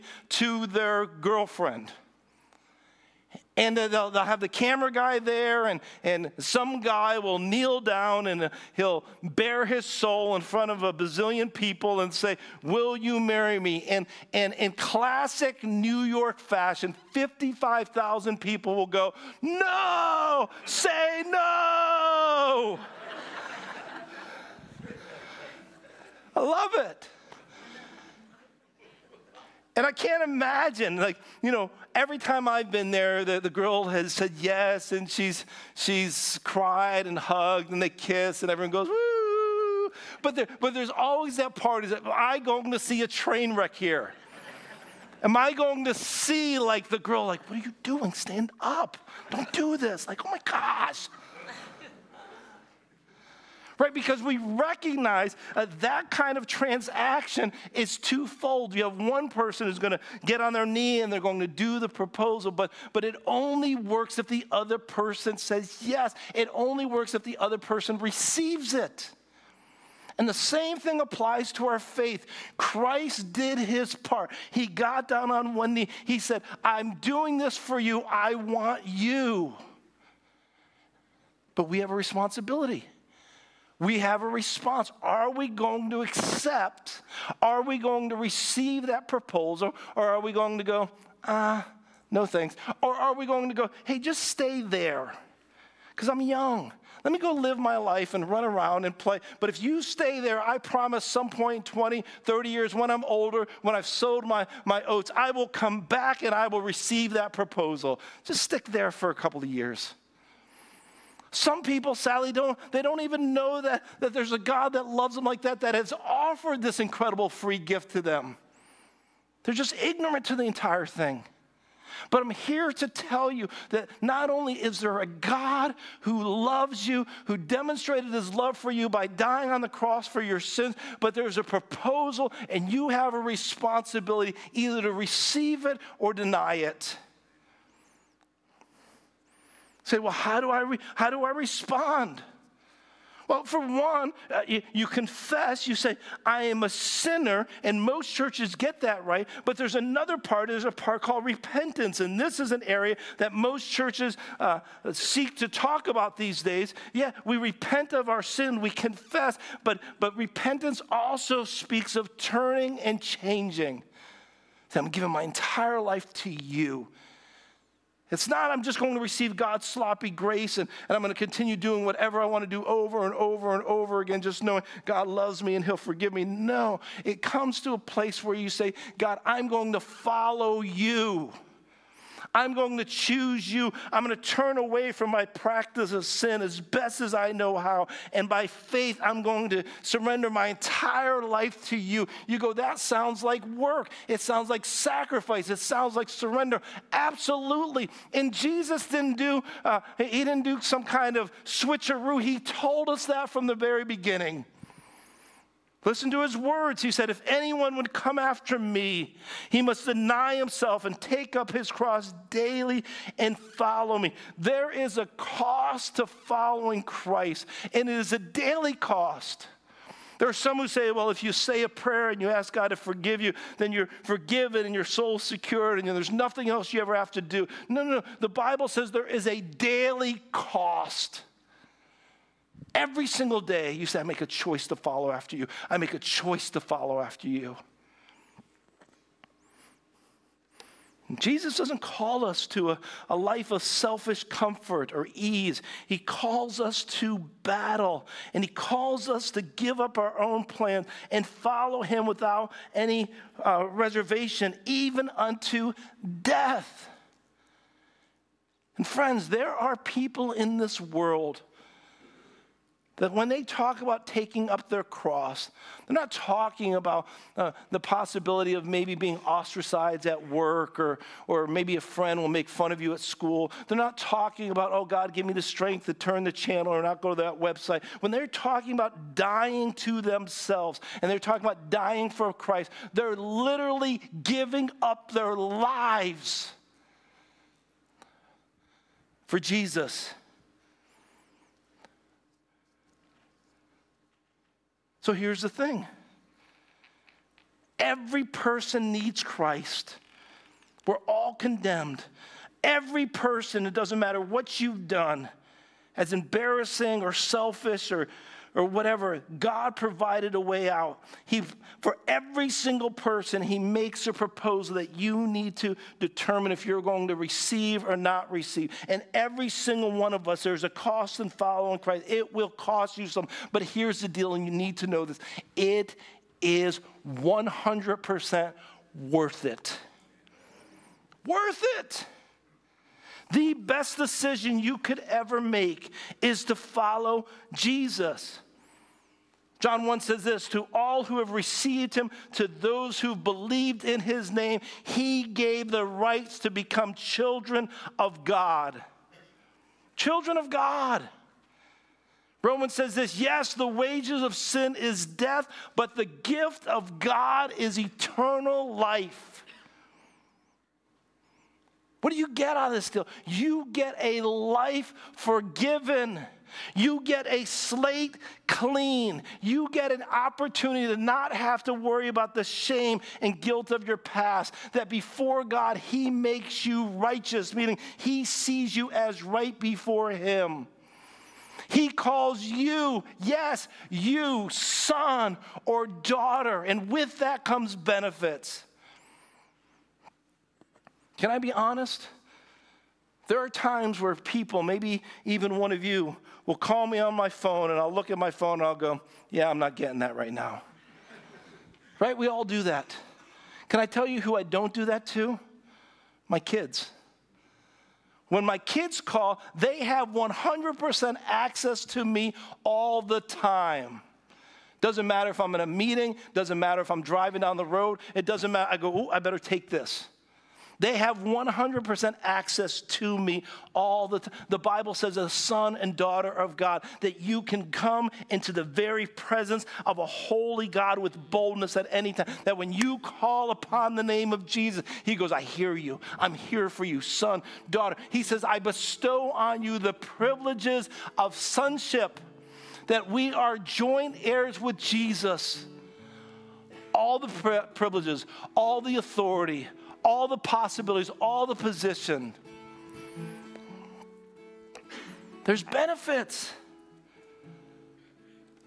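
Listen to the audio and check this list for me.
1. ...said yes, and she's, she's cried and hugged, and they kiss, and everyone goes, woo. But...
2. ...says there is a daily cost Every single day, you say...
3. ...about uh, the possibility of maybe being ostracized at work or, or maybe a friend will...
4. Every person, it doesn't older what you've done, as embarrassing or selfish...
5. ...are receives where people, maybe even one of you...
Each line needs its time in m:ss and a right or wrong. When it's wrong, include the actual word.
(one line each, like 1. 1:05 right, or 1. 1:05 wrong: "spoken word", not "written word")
1. 0:34 right
2. 3:48 right
3. 4:26 right
4. 5:02 wrong: "matter", not "older"
5. 6:33 wrong: "times", not "receives".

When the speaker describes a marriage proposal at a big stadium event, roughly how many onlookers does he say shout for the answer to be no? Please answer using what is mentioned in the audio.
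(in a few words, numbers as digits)
55,000.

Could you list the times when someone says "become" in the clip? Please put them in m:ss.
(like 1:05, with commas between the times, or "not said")
5:46.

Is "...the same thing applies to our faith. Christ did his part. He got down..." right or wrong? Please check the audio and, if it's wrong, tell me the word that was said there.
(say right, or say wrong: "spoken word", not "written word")
right.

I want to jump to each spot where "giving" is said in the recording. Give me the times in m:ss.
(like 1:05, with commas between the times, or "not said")
2:44, 4:44.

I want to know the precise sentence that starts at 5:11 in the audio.
He, for every single person, He makes a proposal that you need to determine if you're going to receive or not receive.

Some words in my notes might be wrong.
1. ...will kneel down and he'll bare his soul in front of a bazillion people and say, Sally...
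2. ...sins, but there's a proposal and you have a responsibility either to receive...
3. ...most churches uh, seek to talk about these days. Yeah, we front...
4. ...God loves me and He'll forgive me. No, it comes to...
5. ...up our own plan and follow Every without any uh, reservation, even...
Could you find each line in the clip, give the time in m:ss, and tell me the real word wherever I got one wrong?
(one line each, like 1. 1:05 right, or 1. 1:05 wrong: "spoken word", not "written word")
1. 0:07 wrong: "Will", not "Sally"
2. 2:10 right
3. 2:33 wrong: "repent", not "front"
4. 2:54 right
5. 4:09 wrong: "Him", not "Every".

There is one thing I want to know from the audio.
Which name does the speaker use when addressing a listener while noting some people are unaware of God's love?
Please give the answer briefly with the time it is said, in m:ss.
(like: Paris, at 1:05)
Sally, at 1:51.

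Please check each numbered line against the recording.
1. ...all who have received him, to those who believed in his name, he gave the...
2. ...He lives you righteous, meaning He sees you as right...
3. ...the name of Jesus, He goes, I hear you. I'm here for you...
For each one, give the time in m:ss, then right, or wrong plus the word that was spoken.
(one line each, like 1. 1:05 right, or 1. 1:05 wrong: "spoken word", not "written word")
1. 5:40 right
2. 6:15 wrong: "makes", not "lives"
3. 7:13 right.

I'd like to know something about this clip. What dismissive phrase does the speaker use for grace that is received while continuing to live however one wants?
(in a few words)
sloppy grace.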